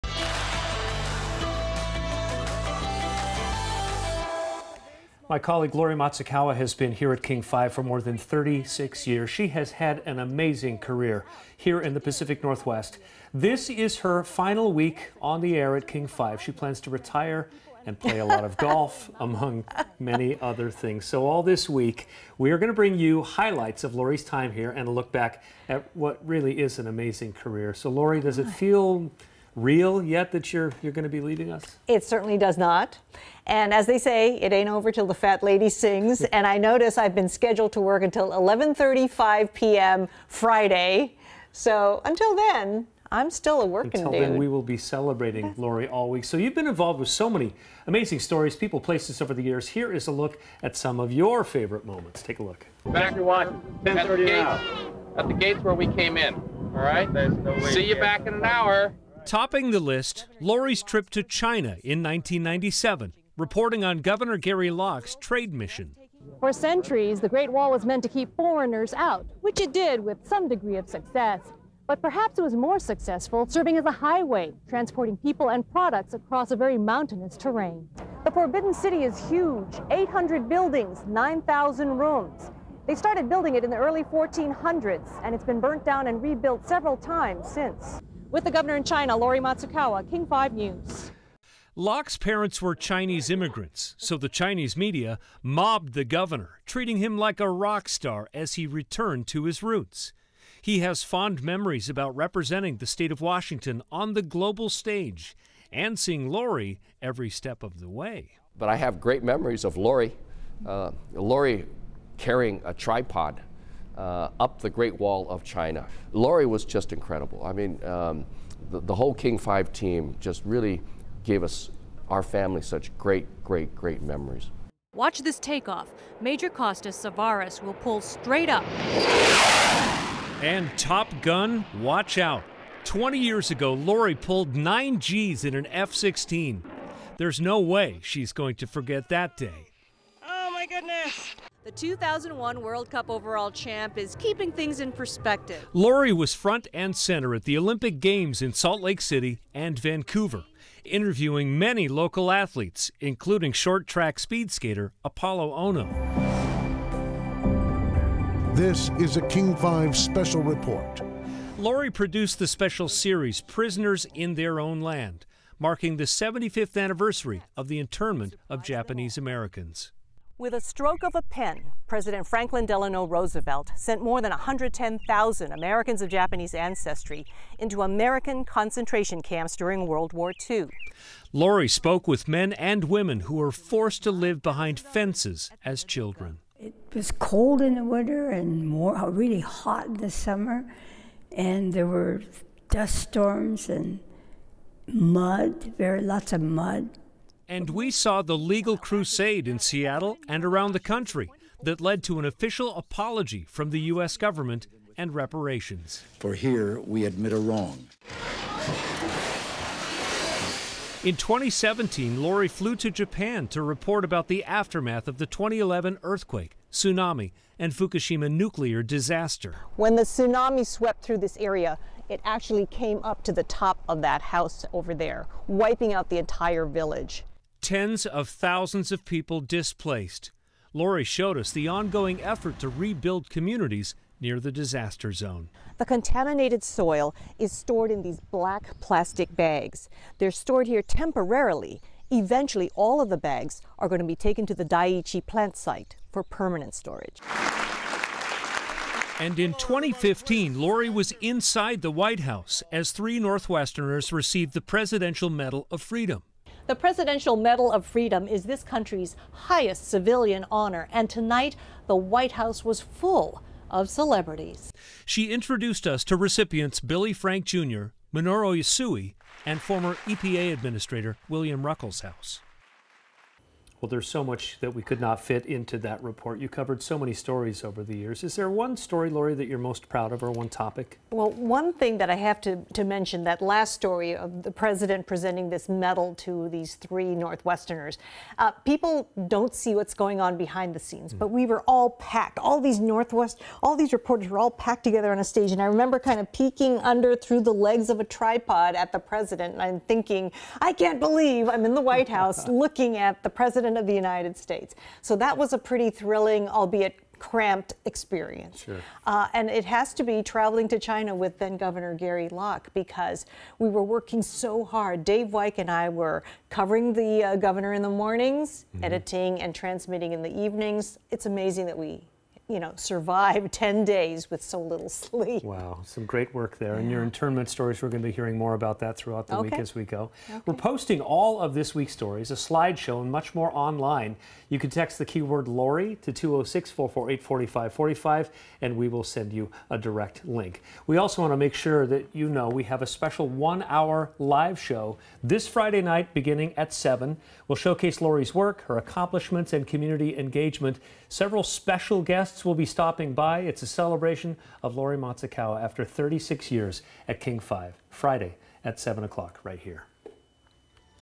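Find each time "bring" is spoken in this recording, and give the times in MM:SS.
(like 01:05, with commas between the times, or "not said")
00:22.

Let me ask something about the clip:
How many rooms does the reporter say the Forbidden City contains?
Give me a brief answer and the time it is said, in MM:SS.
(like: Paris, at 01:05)
9,000, at 01:21.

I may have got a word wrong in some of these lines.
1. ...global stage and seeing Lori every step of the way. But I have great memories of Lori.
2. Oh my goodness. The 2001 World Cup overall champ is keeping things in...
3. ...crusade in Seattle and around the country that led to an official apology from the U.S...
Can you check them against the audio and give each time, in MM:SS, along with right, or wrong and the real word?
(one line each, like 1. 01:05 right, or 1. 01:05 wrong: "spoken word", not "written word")
1. 01:44 right
2. 02:20 right
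3. 03:18 right.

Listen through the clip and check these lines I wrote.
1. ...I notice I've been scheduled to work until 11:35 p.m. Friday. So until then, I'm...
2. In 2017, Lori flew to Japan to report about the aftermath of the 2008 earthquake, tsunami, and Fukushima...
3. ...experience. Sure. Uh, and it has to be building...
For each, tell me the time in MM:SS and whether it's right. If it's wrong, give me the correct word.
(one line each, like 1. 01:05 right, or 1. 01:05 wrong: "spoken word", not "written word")
1. 00:36 right
2. 03:31 wrong: "2011", not "2008"
3. 05:07 wrong: "traveling", not "building".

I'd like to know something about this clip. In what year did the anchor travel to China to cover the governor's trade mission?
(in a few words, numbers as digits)
1997.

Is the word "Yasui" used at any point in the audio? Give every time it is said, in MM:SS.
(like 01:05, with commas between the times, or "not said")
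04:28.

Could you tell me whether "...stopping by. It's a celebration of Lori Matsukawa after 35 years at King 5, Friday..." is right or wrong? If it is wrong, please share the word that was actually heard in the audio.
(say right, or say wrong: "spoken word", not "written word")
wrong: "36", not "35".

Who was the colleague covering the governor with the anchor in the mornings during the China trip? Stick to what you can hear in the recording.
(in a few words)
Dave Weick.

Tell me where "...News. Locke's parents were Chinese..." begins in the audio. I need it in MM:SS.
01:30.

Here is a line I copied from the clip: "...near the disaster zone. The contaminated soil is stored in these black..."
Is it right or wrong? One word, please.
right.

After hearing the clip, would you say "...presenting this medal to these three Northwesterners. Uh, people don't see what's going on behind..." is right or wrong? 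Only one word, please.
right.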